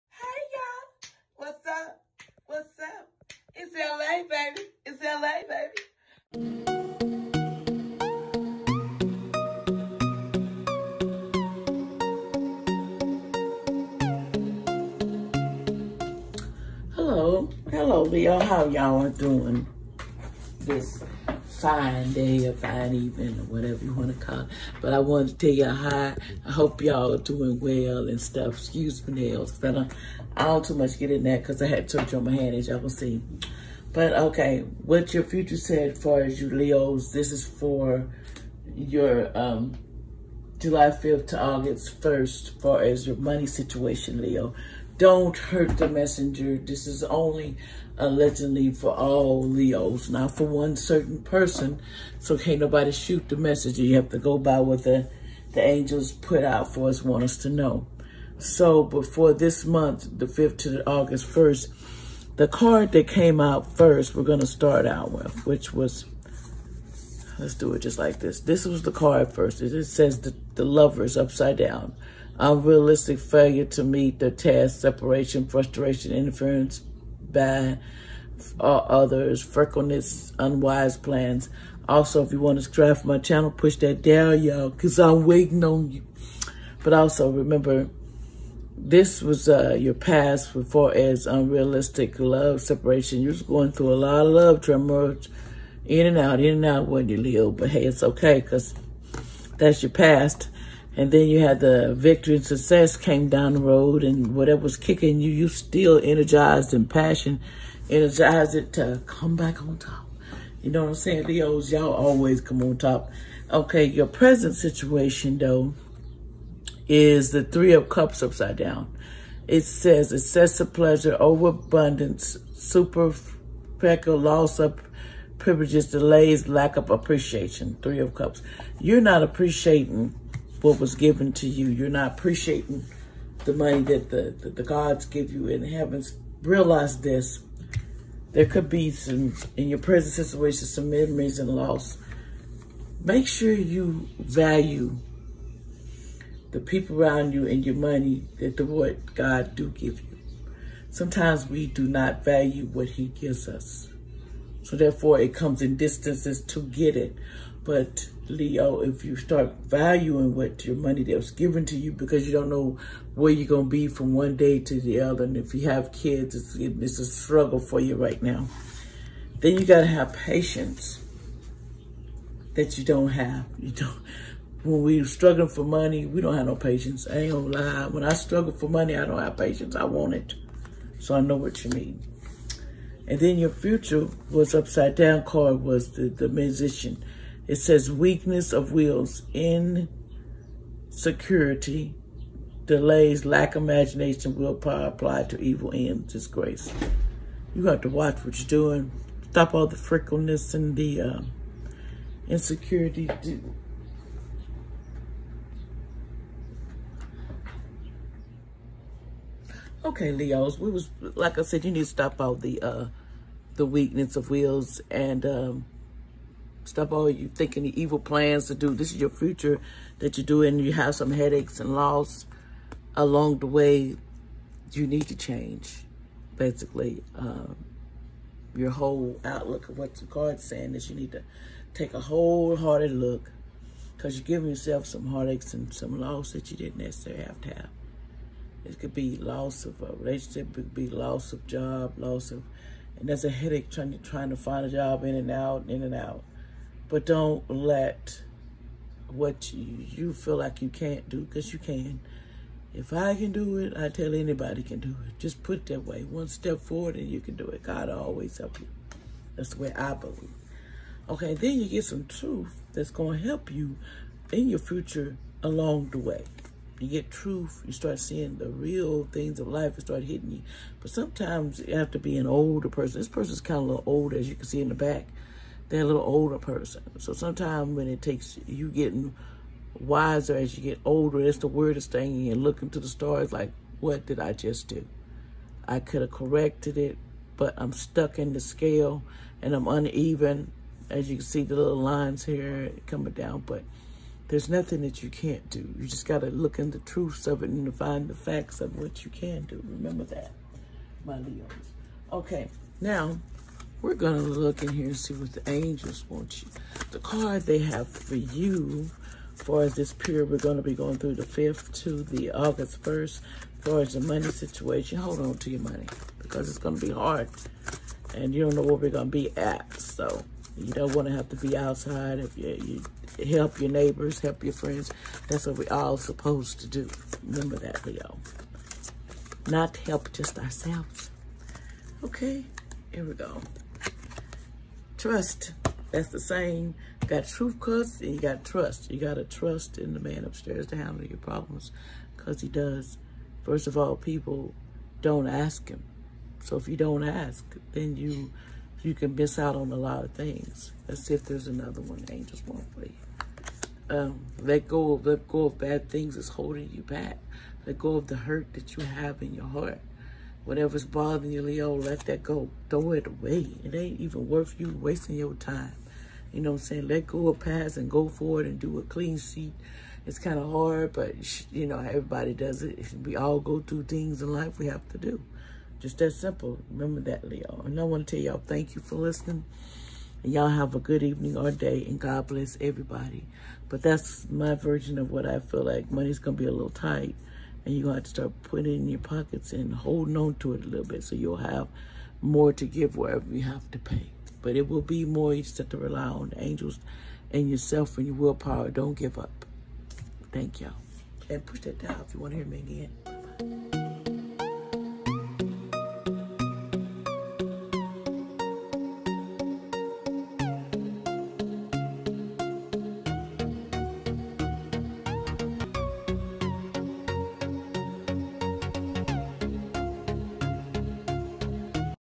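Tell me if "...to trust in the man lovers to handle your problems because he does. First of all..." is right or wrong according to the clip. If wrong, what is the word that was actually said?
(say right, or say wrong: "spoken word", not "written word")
wrong: "upstairs", not "lovers".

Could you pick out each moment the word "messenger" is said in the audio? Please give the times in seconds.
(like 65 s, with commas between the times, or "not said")
45 s, 53 s.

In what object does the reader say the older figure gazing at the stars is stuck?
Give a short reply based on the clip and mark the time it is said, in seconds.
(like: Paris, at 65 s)
The scale, at 288 s.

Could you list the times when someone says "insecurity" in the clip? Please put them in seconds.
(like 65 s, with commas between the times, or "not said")
189 s, 202 s.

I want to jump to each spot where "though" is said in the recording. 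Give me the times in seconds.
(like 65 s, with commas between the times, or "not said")
115 s.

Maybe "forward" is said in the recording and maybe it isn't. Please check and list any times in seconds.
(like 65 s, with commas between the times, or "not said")
256 s, 368 s.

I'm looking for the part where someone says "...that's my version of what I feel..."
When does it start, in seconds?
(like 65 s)
383 s.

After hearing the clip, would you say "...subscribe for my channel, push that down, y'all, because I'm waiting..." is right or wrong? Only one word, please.
right.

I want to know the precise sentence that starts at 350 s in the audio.
Let's see if there's another one.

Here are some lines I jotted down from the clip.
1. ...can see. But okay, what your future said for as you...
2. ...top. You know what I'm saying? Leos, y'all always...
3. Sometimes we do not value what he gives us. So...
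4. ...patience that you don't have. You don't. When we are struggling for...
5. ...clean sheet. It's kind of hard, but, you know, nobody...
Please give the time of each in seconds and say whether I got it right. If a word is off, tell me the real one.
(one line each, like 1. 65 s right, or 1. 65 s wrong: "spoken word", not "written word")
1. 32 s right
2. 109 s right
3. 150 s right
4. 170 s right
5. 368 s wrong: "everybody", not "nobody".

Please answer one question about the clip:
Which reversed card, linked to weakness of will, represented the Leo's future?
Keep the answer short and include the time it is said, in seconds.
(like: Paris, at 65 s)
The Musician, at 186 s.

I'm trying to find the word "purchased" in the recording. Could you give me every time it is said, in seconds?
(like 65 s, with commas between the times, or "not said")
not said.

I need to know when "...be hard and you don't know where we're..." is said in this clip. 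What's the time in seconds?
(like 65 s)
316 s.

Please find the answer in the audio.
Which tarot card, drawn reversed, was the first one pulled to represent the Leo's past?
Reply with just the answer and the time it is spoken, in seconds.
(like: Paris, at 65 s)
The Lovers, at 70 s.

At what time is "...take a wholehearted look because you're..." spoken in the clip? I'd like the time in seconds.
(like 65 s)
231 s.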